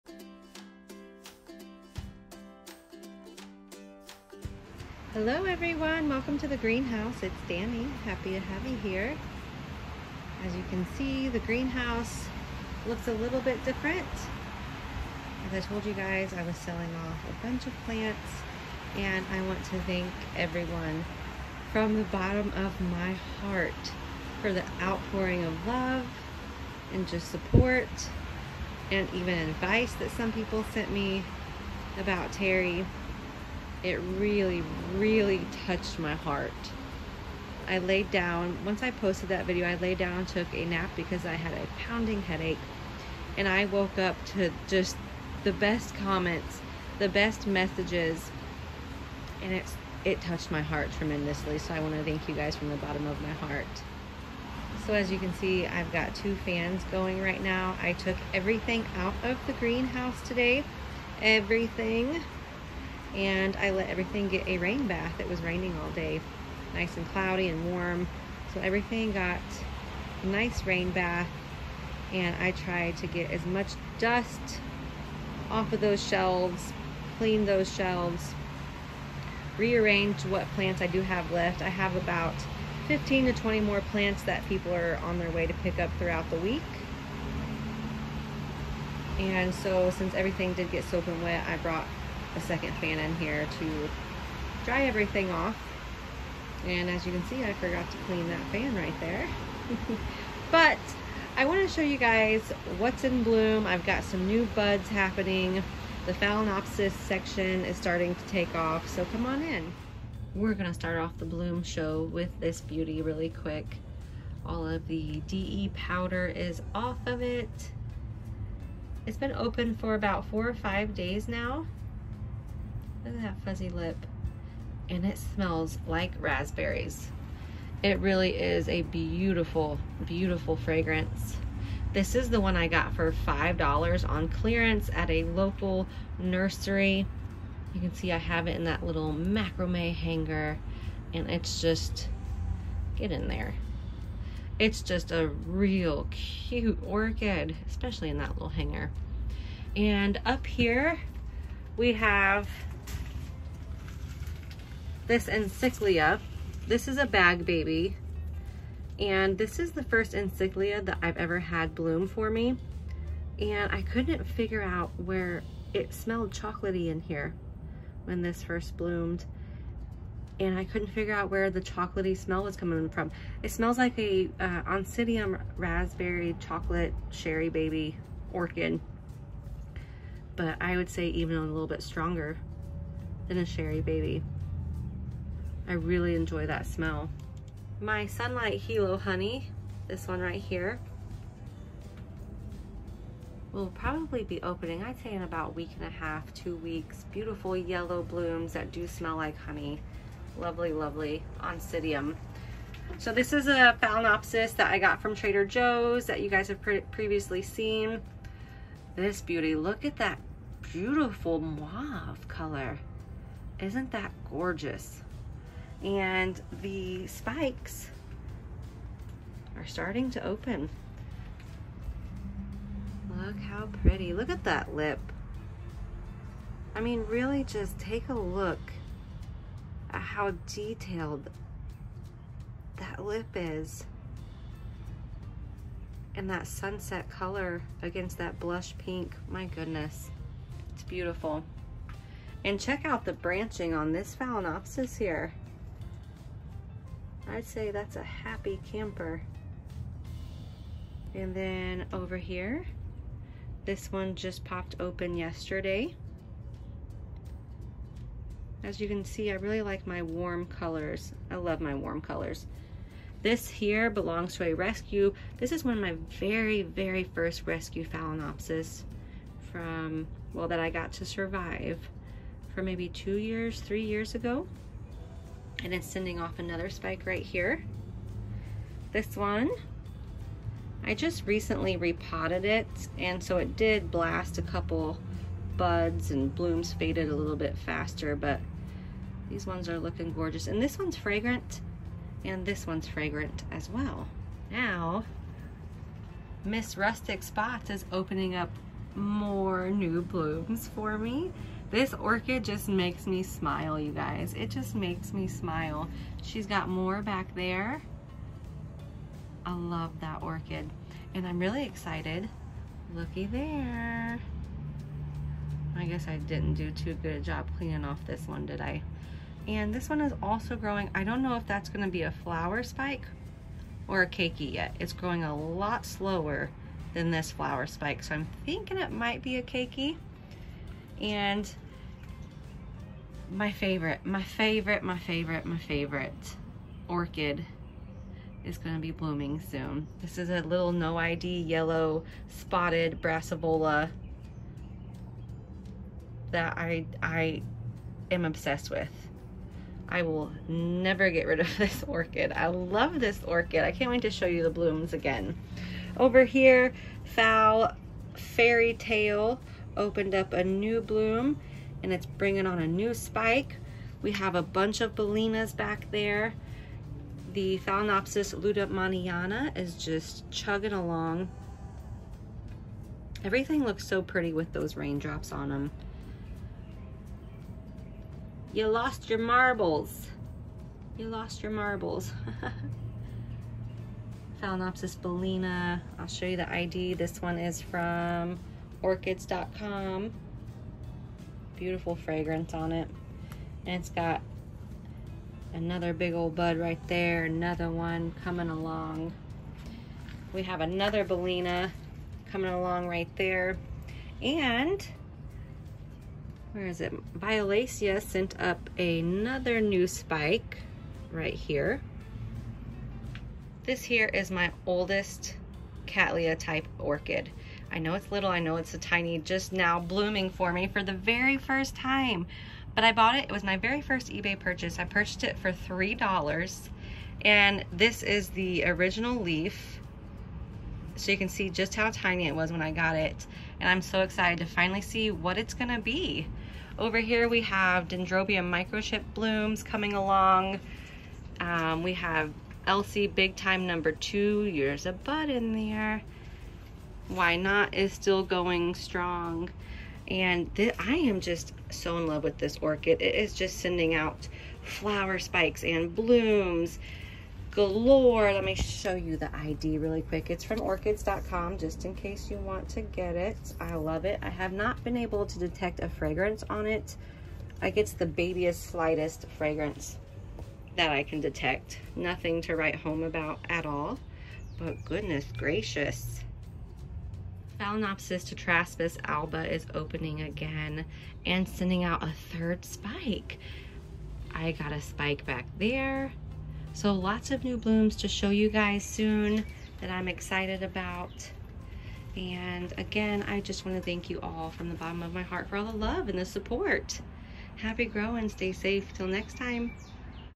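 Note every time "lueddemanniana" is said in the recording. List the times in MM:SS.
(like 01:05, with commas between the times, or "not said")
06:08.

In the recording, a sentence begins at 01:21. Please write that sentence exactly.
I have about 15 to 20 more plants that people are on their way to pick up throughout the week.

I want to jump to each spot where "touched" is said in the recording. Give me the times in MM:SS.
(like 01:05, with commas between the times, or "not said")
00:35, 00:50.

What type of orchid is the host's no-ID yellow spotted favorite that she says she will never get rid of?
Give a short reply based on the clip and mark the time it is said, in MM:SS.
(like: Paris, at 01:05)
Brassavola, at 05:43.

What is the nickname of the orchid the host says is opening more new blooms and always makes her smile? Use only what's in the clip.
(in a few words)
Rustic Spots.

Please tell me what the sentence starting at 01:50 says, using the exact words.
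We're going to start off the bloom show with this beauty really quick.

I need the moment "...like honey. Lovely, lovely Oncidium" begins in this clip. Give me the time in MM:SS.
03:19.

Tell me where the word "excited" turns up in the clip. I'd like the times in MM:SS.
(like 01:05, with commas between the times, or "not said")
05:11, 07:14, 08:10.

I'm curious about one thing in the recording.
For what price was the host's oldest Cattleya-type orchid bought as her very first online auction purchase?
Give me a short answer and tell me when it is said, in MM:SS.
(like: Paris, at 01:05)
$3, at 07:05.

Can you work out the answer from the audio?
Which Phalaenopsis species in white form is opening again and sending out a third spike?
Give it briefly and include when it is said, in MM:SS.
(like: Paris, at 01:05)
Phalaenopsis tetraspis alba, at 07:57.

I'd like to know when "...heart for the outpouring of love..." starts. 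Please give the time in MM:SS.
00:23.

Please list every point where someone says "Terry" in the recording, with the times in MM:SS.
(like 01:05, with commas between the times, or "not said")
00:32.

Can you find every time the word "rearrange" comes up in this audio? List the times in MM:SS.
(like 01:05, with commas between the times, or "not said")
01:19.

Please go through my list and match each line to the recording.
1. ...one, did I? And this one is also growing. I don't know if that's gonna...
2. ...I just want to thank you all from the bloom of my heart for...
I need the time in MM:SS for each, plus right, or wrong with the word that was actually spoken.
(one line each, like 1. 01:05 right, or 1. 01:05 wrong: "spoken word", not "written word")
1. 05:18 right
2. 08:13 wrong: "bottom", not "bloom".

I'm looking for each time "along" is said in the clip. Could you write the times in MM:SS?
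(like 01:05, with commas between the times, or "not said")
06:10, 06:38, 06:42, 07:19.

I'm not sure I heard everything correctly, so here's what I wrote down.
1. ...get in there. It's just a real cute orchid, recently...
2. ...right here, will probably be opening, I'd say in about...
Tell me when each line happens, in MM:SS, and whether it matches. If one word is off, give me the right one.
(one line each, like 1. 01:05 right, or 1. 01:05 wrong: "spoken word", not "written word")
1. 02:22 wrong: "especially", not "recently"
2. 03:10 right.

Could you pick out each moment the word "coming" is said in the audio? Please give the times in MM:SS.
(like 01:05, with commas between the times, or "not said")
02:52, 06:38, 06:42, 07:19.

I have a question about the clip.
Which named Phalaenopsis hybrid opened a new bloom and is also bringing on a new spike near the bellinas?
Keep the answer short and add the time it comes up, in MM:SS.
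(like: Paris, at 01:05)
Fairy Tale, at 05:58.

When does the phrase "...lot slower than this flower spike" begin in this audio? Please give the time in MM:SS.
05:25.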